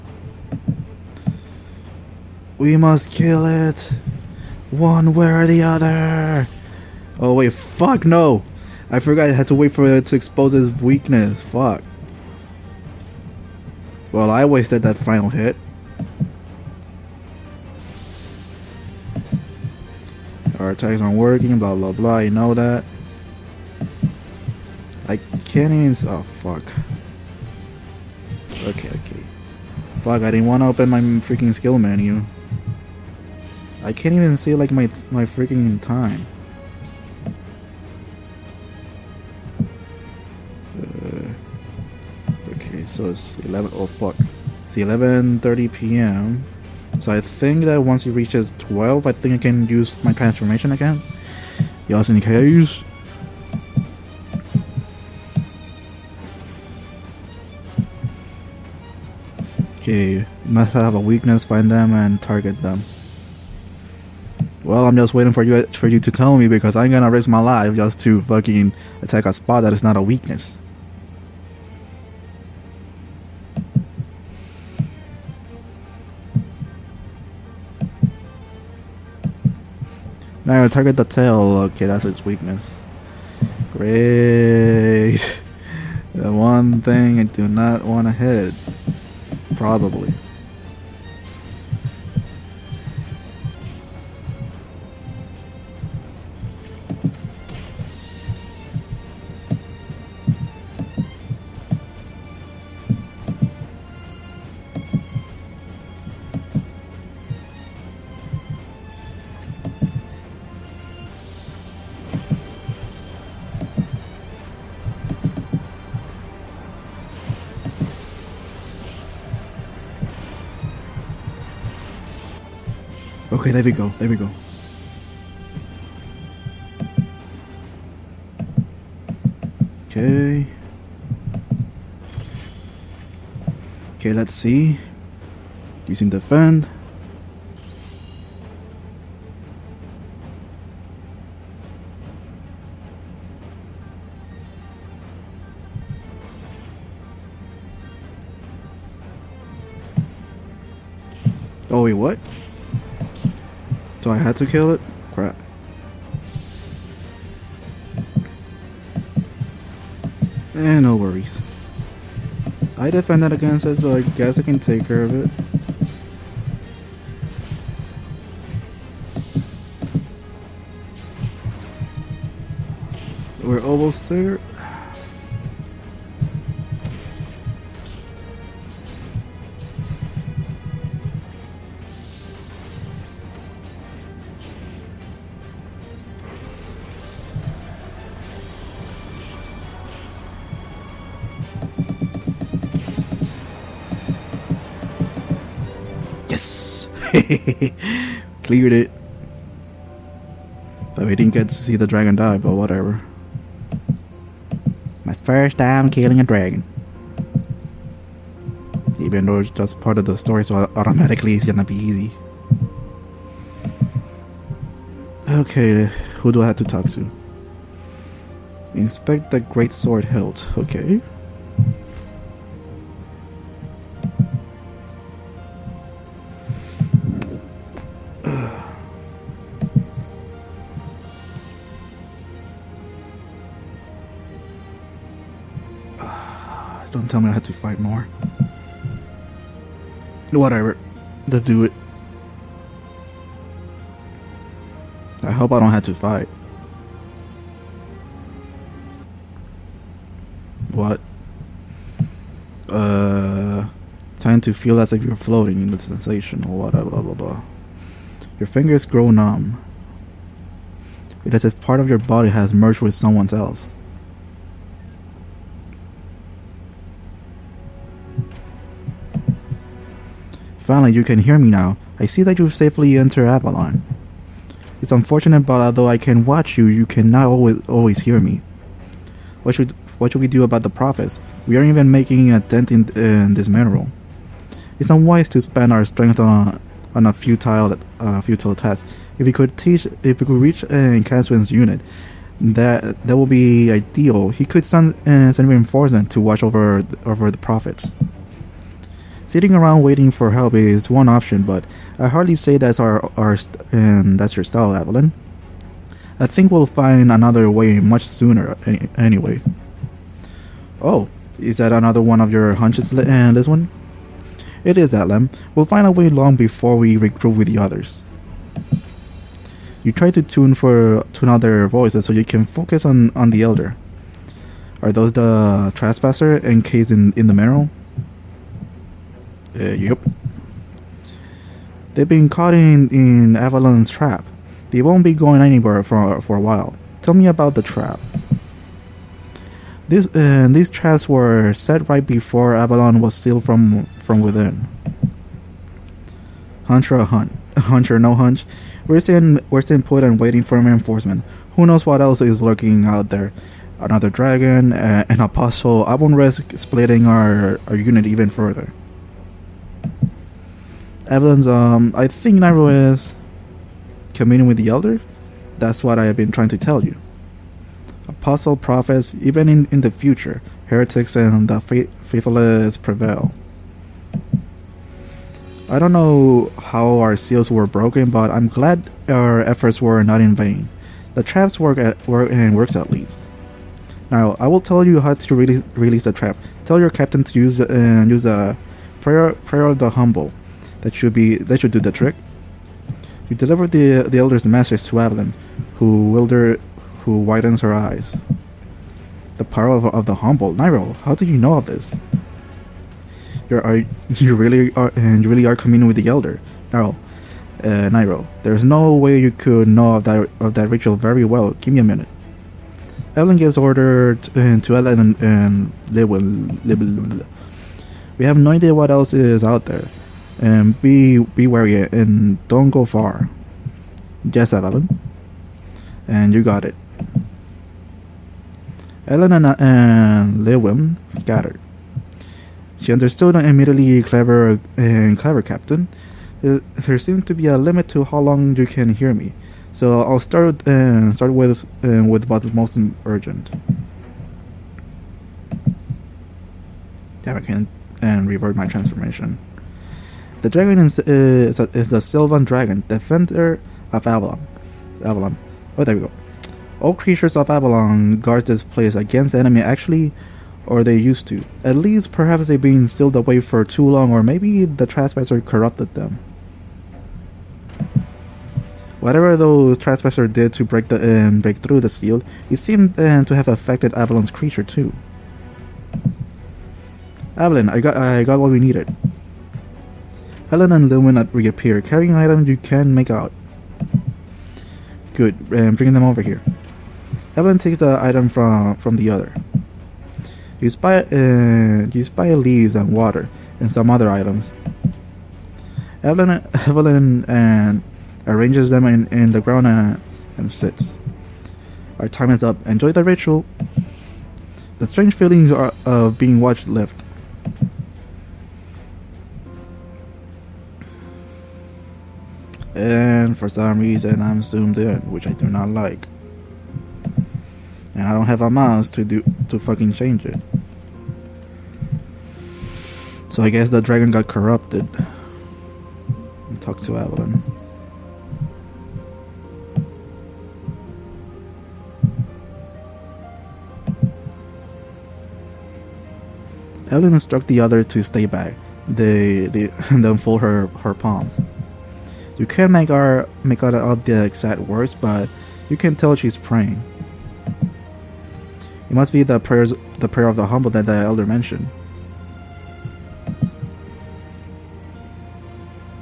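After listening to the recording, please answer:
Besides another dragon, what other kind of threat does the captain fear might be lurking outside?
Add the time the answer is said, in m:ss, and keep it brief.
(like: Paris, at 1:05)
An apostle, at 5:55.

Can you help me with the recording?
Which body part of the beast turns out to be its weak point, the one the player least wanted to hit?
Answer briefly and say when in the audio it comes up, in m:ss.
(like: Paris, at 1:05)
The tail, at 1:20.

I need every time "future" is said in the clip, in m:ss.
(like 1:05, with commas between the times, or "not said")
6:09.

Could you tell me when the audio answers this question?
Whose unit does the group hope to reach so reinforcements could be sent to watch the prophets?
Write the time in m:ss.
4:51.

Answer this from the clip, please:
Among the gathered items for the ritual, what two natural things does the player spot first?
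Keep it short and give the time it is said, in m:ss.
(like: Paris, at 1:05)
Leaves and water, at 8:12.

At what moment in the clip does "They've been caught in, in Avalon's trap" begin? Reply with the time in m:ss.
5:31.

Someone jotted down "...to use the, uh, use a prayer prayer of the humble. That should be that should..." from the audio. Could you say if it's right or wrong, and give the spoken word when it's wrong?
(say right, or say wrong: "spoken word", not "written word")
right.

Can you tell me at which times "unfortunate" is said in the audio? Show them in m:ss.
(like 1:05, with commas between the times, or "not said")
4:34.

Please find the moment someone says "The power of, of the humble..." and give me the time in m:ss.
6:39.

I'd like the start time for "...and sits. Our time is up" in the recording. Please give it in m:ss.
8:20.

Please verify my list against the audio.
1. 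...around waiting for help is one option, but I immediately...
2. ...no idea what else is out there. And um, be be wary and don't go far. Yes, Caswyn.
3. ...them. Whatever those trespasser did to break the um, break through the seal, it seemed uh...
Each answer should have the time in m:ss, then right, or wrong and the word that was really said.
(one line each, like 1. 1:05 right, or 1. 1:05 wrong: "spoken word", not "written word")
1. 4:59 wrong: "hardly", not "immediately"
2. 6:58 wrong: "Evelyn", not "Caswyn"
3. 7:45 right.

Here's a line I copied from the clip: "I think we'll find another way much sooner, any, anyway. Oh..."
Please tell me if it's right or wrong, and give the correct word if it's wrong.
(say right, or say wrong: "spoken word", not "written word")
right.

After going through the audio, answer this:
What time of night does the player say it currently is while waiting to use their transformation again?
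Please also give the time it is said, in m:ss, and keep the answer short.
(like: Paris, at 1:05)
11:30 p.m., at 0:44.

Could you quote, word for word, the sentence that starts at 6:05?
That's what I have been trying to tell you.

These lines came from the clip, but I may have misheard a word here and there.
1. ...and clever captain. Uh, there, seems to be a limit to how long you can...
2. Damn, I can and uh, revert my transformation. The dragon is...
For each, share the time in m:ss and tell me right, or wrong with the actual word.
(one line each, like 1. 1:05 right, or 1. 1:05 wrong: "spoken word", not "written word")
1. 7:14 right
2. 7:27 right.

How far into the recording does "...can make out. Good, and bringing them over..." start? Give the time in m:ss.
8:02.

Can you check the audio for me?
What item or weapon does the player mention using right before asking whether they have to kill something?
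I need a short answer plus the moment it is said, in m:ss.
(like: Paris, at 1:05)
The fan, at 2:16.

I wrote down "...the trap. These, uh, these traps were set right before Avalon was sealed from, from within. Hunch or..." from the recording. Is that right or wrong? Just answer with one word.
right.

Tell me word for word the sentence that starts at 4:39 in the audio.
What should what should we do about the prophets?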